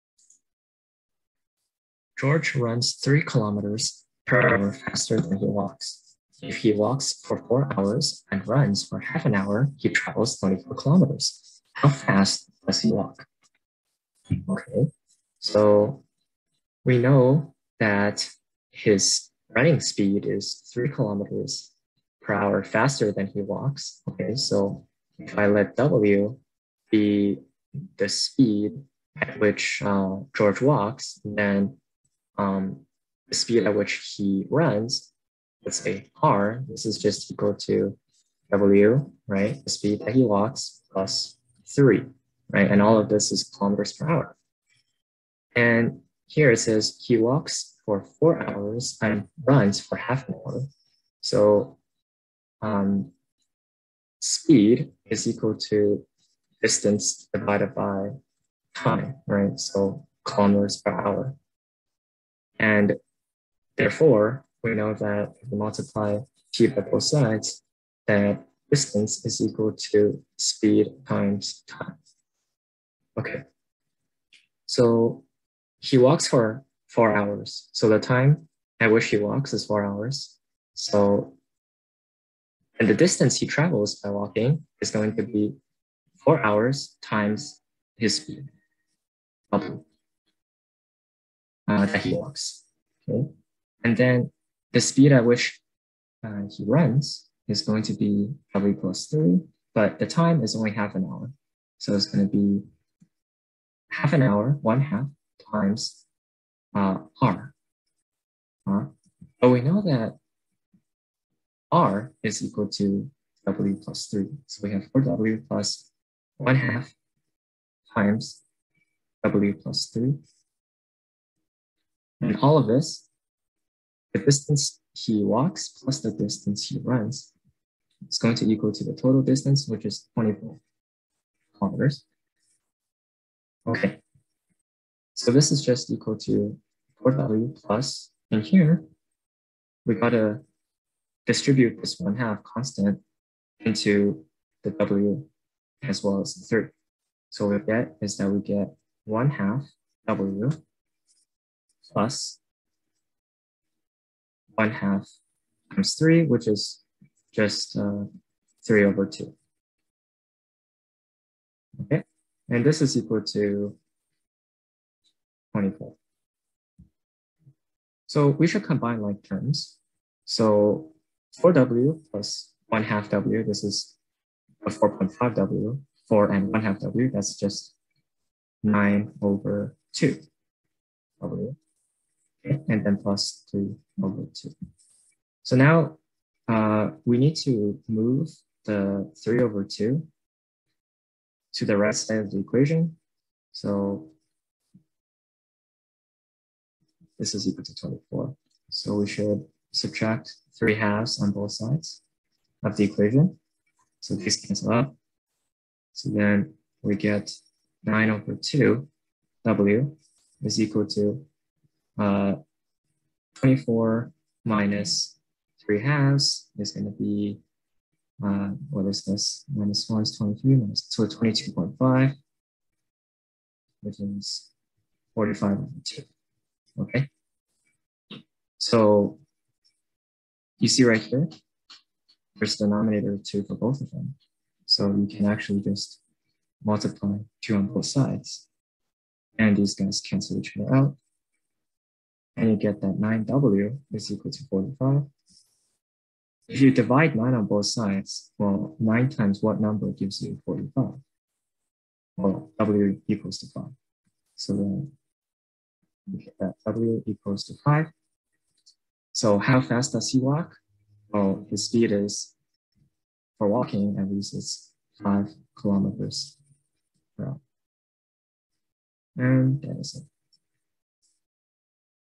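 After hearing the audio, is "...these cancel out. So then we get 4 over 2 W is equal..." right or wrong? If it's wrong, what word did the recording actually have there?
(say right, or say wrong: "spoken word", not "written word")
wrong: "9", not "4".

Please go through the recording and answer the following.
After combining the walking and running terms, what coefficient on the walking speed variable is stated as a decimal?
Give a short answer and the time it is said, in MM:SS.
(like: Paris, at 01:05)
4.5, at 02:54.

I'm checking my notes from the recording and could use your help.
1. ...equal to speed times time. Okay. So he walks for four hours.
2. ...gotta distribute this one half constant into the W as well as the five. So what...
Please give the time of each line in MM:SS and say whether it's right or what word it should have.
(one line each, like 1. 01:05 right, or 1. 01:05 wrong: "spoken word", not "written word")
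1. 01:09 right
2. 02:19 wrong: "three", not "five".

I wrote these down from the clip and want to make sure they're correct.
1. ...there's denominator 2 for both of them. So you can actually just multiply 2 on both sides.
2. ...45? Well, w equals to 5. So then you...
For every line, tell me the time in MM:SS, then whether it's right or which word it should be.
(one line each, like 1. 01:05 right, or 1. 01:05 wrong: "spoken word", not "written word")
1. 03:52 right
2. 04:10 right.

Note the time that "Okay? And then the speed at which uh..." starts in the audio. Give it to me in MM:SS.
01:33.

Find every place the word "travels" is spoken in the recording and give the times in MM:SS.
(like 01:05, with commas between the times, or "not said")
00:09, 01:23.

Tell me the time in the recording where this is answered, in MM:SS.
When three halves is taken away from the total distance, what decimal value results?
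03:41.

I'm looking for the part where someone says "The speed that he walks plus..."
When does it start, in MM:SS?
00:39.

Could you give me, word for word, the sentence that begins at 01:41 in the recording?
So it's going to be half an hour, one half times uh, R.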